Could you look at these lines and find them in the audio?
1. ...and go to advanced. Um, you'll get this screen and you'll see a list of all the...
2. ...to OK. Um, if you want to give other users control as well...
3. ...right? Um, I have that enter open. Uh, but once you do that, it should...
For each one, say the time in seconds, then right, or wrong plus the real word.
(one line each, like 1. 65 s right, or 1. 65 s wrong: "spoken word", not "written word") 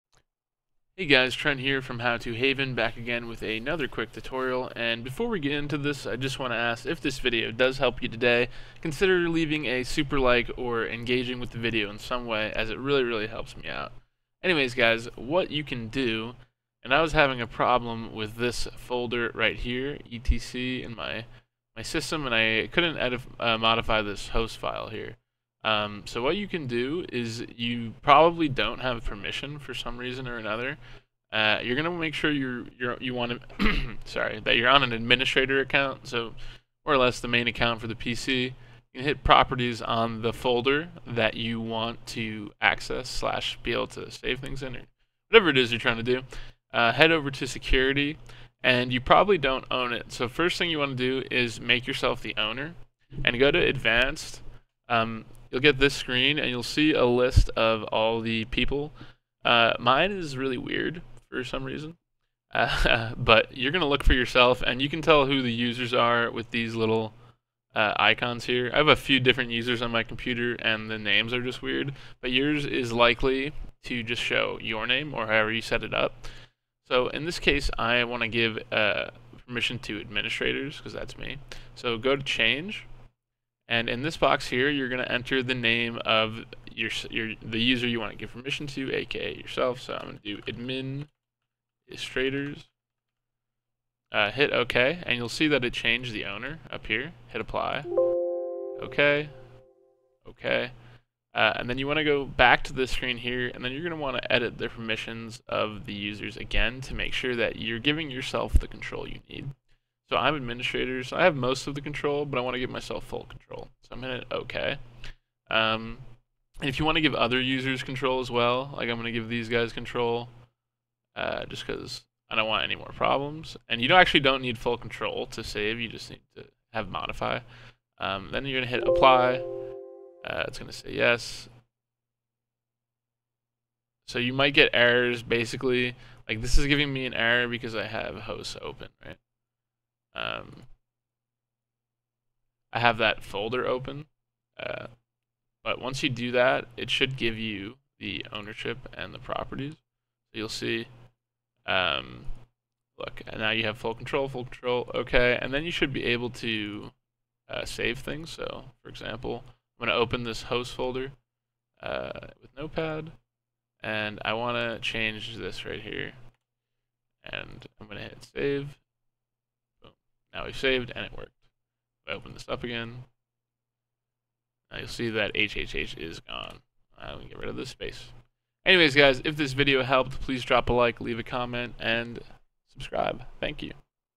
1. 53 s right
2. 114 s right
3. 139 s wrong: "folder", not "enter".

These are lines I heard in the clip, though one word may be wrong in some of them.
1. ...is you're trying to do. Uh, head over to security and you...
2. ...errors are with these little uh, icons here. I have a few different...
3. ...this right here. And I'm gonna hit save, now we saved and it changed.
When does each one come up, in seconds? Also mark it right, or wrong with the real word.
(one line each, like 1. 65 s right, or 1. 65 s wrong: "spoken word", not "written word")
1. 45 s right
2. 65 s wrong: "users", not "errors"
3. 165 s wrong: "worked", not "changed".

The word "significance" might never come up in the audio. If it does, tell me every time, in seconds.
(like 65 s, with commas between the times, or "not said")
not said.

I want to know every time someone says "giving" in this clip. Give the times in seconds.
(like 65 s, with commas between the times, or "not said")
107 s, 136 s.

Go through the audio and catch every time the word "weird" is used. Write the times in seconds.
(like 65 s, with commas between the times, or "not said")
60 s, 71 s.